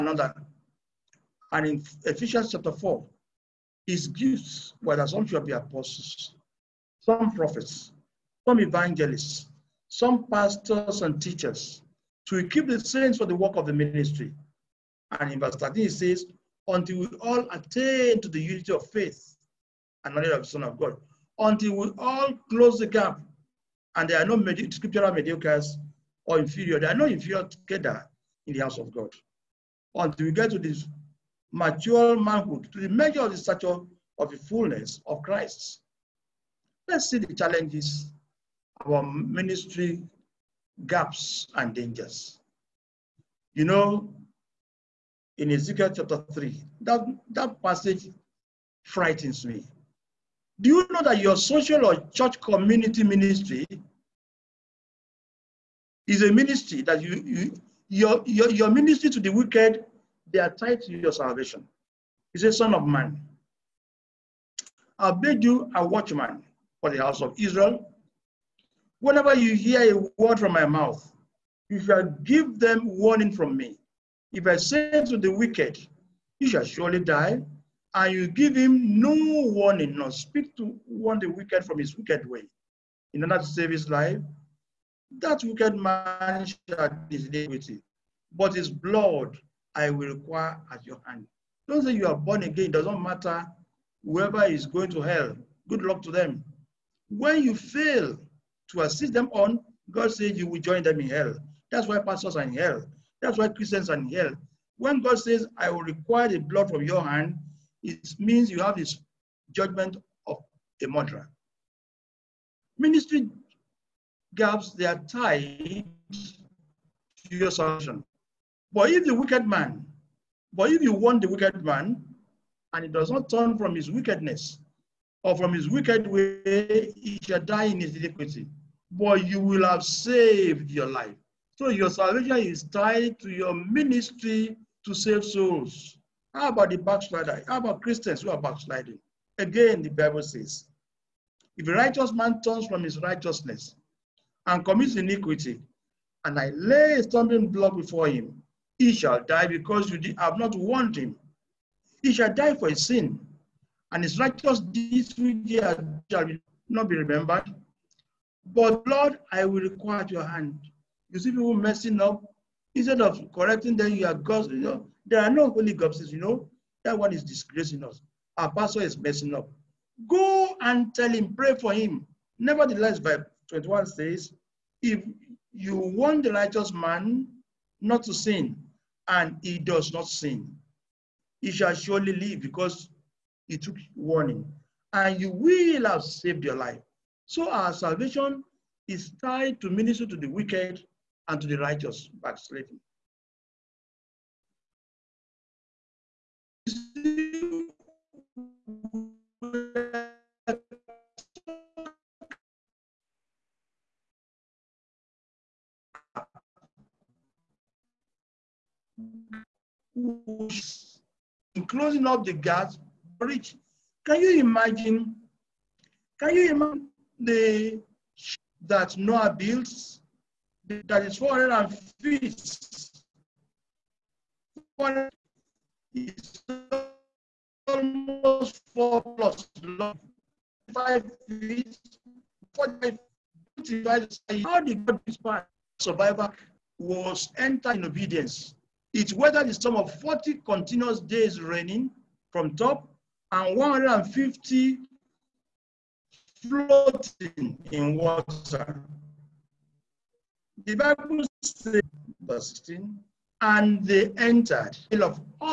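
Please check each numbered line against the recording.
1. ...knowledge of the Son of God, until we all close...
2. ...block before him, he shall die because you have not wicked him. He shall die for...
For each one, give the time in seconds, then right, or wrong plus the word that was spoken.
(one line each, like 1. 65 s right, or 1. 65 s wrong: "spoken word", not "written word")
1. 20 s right
2. 147 s wrong: "warned", not "wicked".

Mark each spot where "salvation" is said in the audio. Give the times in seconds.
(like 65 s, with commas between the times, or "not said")
61 s, 117 s, 131 s, 187 s.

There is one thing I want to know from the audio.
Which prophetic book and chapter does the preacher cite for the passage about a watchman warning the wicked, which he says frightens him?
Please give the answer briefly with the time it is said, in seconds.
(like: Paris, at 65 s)
Ezekiel chapter 3, at 45 s.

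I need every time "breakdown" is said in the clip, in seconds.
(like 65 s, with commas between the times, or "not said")
not said.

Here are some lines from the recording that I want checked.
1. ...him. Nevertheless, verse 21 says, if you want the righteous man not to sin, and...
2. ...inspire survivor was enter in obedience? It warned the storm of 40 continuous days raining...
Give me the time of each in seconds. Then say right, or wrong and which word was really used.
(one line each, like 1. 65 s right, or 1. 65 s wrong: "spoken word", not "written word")
1. 171 s right
2. 235 s wrong: "weathered", not "warned".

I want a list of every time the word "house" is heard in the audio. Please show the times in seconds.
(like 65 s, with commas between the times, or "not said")
28 s, 67 s.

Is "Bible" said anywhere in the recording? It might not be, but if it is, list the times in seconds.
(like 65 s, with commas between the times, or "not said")
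139 s, 250 s.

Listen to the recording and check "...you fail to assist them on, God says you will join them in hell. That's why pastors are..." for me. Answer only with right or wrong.
right.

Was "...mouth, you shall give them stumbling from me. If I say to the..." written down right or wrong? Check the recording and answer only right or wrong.
wrong.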